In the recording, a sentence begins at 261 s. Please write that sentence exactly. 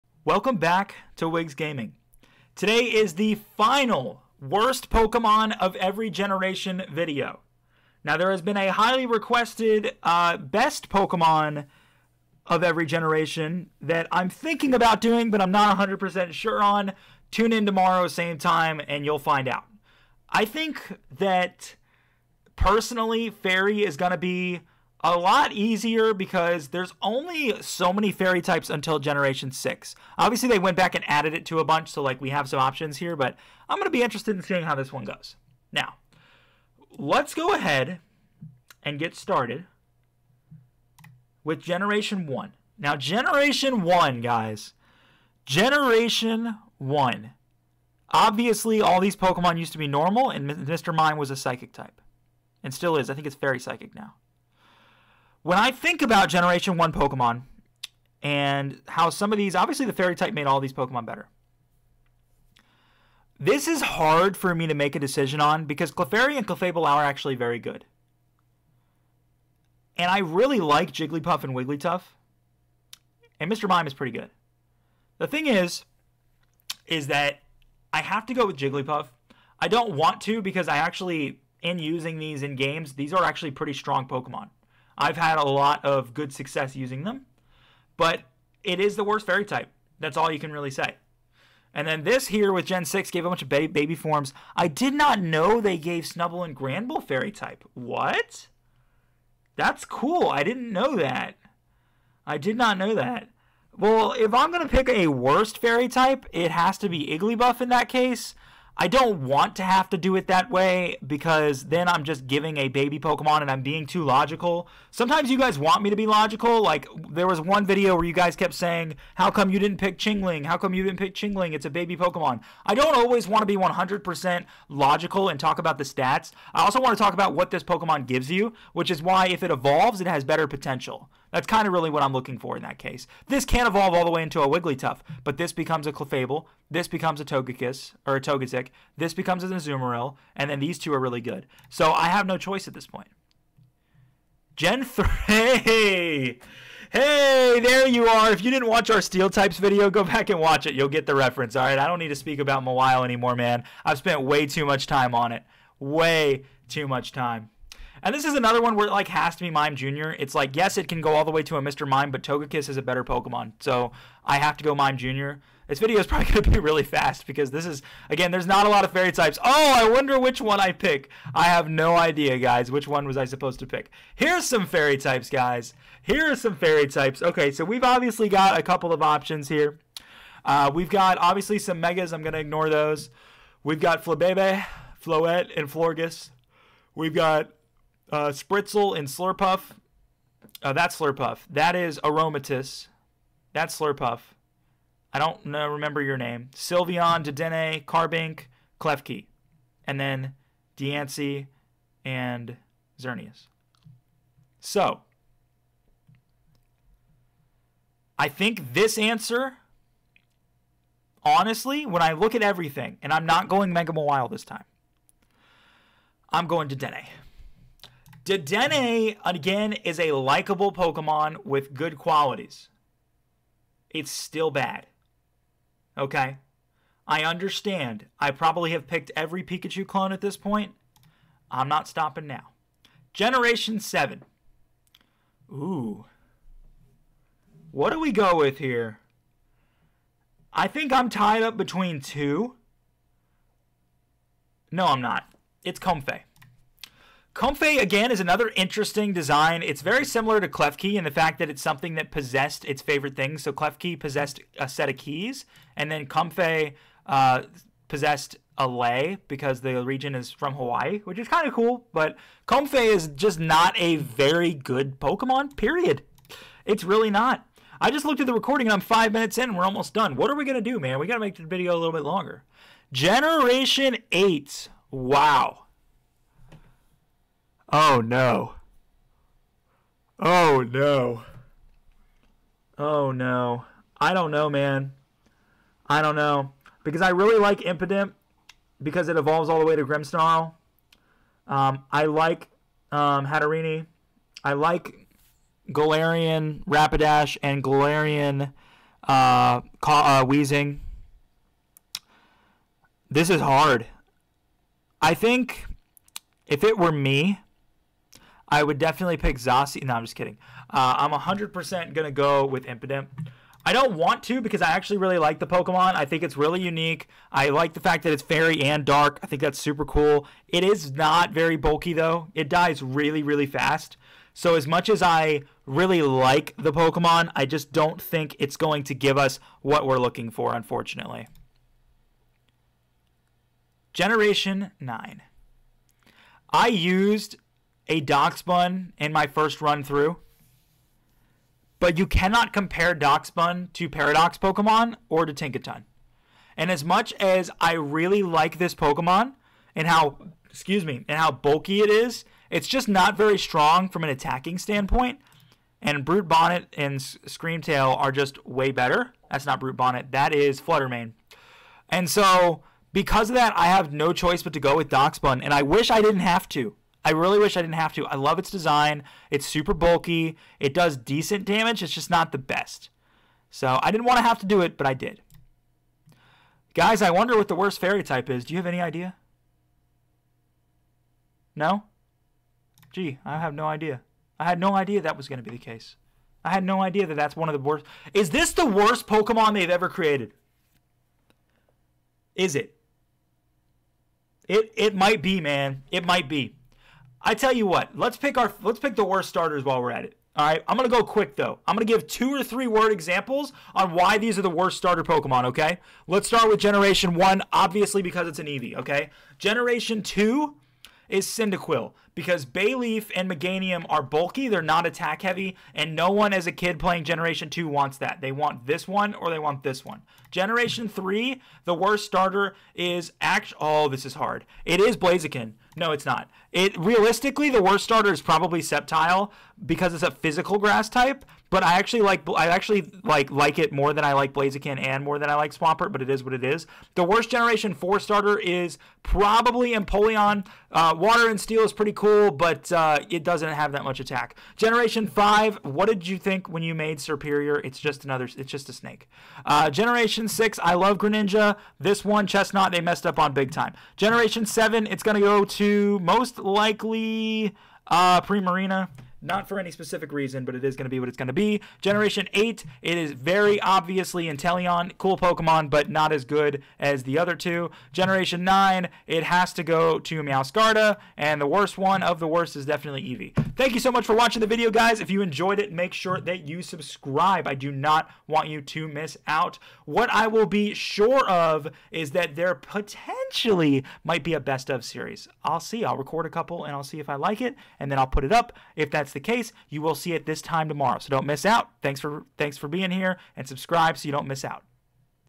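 But Comfey is just not a very good Pokemon, period.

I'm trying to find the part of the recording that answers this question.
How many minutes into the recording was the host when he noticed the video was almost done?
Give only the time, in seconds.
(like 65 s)
268 s.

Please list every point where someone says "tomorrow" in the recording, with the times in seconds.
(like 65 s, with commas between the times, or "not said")
17 s, 490 s.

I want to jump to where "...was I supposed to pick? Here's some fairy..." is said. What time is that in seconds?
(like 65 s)
173 s.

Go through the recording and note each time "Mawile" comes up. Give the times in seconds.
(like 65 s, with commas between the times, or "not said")
152 s, 213 s.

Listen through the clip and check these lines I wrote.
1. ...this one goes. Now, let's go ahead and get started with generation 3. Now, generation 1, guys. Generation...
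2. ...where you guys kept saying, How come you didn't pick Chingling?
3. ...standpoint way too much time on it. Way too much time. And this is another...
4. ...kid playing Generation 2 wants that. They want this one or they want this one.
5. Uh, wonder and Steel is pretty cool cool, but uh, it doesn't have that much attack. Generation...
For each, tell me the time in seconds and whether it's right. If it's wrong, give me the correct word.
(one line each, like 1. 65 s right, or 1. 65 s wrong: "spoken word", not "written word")
1. 34 s wrong: "1", not "3"
2. 117 s right
3. 153 s wrong: "spent", not "standpoint"
4. 416 s right
5. 440 s wrong: "water", not "wonder".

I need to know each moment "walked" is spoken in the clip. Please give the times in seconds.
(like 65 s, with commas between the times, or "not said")
not said.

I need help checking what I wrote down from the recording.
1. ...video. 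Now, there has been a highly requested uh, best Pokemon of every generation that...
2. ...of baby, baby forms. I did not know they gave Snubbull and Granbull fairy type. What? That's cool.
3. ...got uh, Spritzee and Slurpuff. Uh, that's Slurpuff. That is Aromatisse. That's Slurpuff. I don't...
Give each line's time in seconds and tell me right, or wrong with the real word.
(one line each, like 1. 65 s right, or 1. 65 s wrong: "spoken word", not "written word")
1. 6 s right
2. 93 s right
3. 187 s right.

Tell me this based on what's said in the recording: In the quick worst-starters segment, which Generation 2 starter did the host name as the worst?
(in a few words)
Cyndaquil.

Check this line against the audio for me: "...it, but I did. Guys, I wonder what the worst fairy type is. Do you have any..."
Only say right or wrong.
right.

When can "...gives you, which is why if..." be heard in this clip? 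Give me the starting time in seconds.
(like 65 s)
128 s.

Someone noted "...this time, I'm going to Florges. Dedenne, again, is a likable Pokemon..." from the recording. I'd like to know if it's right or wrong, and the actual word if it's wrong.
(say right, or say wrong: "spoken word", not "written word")
wrong: "Dene", not "Florges".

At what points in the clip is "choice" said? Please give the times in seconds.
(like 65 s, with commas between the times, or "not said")
142 s, 364 s.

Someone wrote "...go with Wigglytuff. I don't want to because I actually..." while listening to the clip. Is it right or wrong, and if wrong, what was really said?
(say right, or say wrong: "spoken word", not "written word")
wrong: "Jigglypuff", not "Wigglytuff".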